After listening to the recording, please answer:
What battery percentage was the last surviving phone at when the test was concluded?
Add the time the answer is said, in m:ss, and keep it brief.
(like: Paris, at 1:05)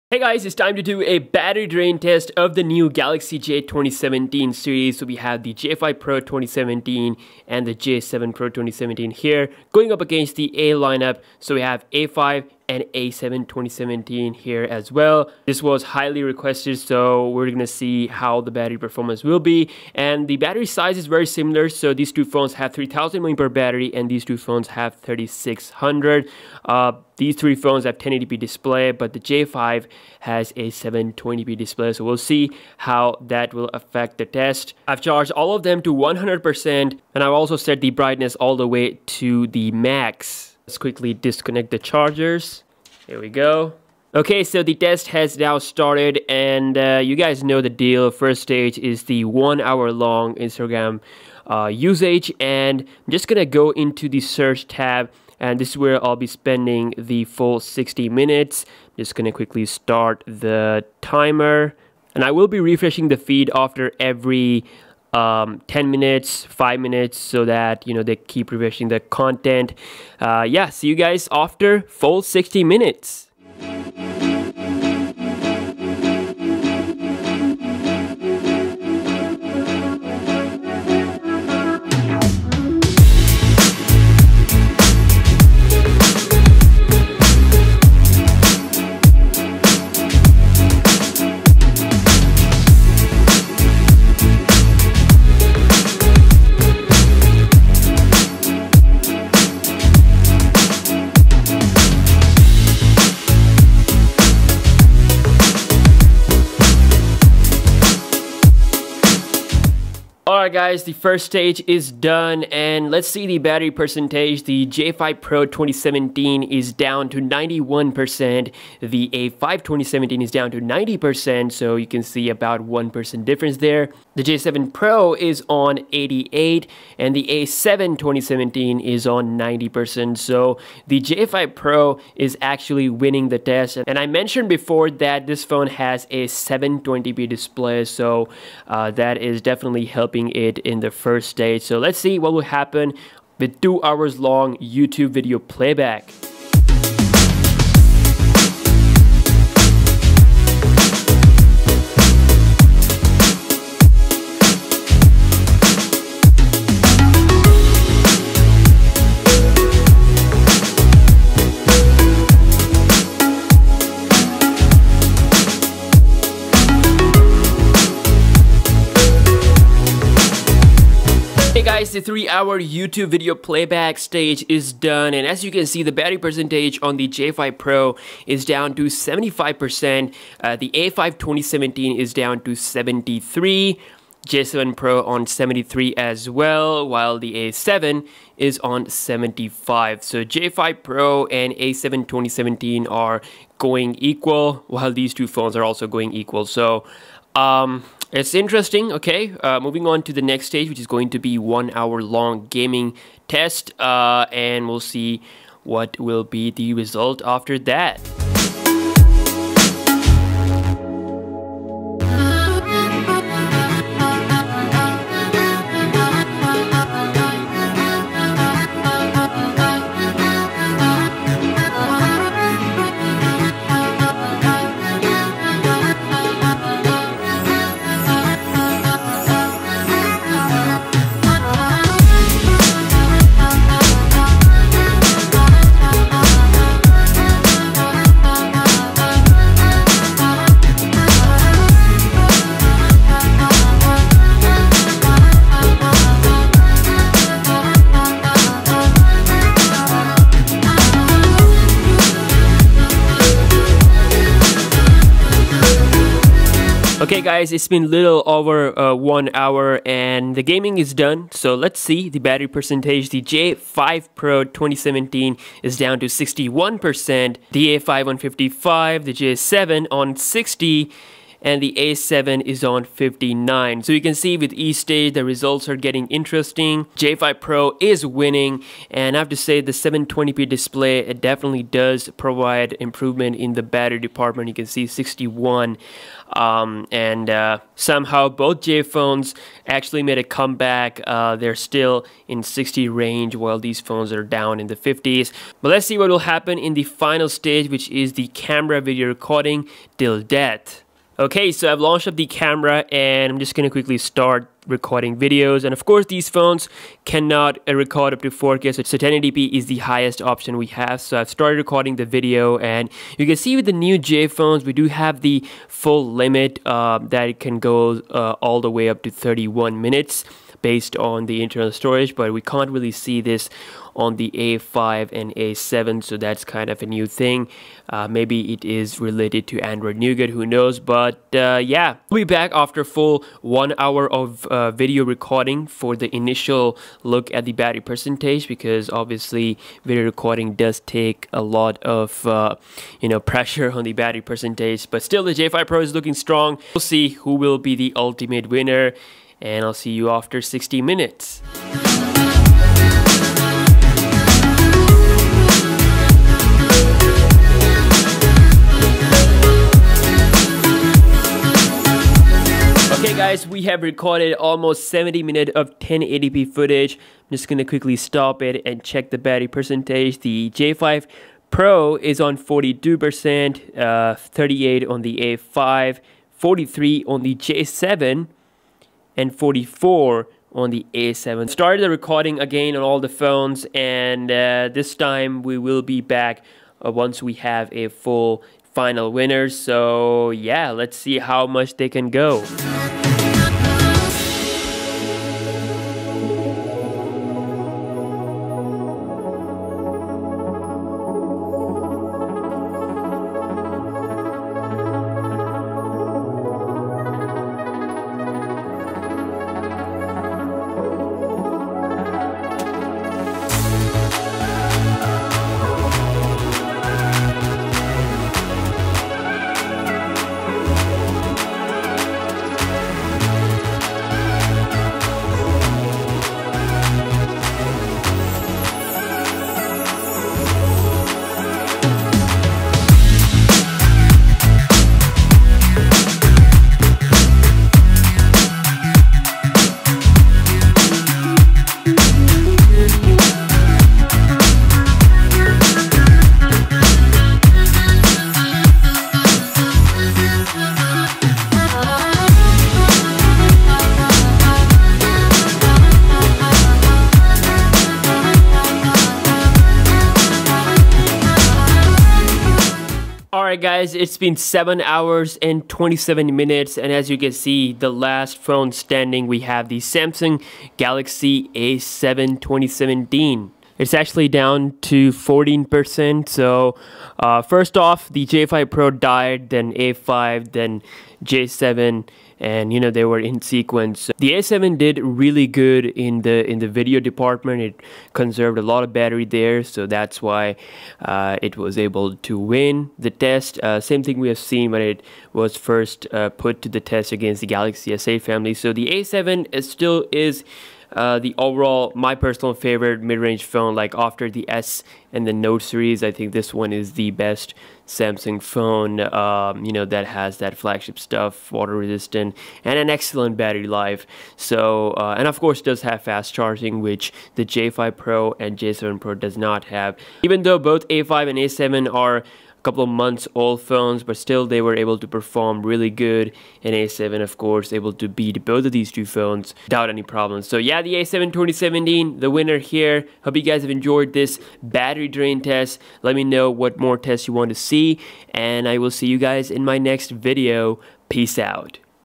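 14%, at 7:55.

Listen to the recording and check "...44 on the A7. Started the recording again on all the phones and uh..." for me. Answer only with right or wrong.
right.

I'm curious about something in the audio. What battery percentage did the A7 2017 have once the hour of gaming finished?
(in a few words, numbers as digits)
59%.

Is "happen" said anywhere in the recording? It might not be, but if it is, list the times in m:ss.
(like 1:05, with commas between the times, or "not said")
2:22, 4:56.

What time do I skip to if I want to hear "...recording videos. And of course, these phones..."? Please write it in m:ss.
5:04.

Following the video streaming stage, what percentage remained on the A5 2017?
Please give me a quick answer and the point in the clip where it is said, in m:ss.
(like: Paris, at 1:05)
73%, at 3:02.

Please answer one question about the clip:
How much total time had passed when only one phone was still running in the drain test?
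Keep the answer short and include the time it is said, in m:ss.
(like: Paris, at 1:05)
7 hours 27 minutes, at 7:44.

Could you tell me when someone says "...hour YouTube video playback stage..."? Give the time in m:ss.
2:52.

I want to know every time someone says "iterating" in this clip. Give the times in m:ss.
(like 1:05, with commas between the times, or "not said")
not said.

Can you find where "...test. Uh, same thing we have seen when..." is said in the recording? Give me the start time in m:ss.
8:13.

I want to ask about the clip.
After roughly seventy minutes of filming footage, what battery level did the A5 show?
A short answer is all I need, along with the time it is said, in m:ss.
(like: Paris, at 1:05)
38%, at 6:14.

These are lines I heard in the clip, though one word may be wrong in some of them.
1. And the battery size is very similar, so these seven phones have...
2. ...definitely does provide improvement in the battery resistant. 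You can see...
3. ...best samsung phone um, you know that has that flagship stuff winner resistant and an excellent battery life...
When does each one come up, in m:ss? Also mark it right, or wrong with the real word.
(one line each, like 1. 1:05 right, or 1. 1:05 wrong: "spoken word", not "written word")
1. 0:19 wrong: "two", not "seven"
2. 4:41 wrong: "department", not "resistant"
3. 8:27 wrong: "water", not "winner".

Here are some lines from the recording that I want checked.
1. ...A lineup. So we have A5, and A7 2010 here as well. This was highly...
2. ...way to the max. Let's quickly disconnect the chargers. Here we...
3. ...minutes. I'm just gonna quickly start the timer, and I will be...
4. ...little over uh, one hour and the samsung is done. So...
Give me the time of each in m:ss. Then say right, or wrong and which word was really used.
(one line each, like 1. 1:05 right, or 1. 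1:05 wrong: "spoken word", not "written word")
1. 0:10 wrong: "2017", not "2010"
2. 0:38 right
3. 0:58 right
4. 4:17 wrong: "gaming", not "samsung".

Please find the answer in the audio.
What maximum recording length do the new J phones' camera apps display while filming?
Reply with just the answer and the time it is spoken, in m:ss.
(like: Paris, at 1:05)
31 minutes, at 5:19.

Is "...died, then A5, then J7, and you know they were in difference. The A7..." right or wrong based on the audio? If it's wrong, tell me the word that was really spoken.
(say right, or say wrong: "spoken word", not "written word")
wrong: "sequence", not "difference".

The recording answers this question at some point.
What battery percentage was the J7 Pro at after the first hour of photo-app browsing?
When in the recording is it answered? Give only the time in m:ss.
2:05.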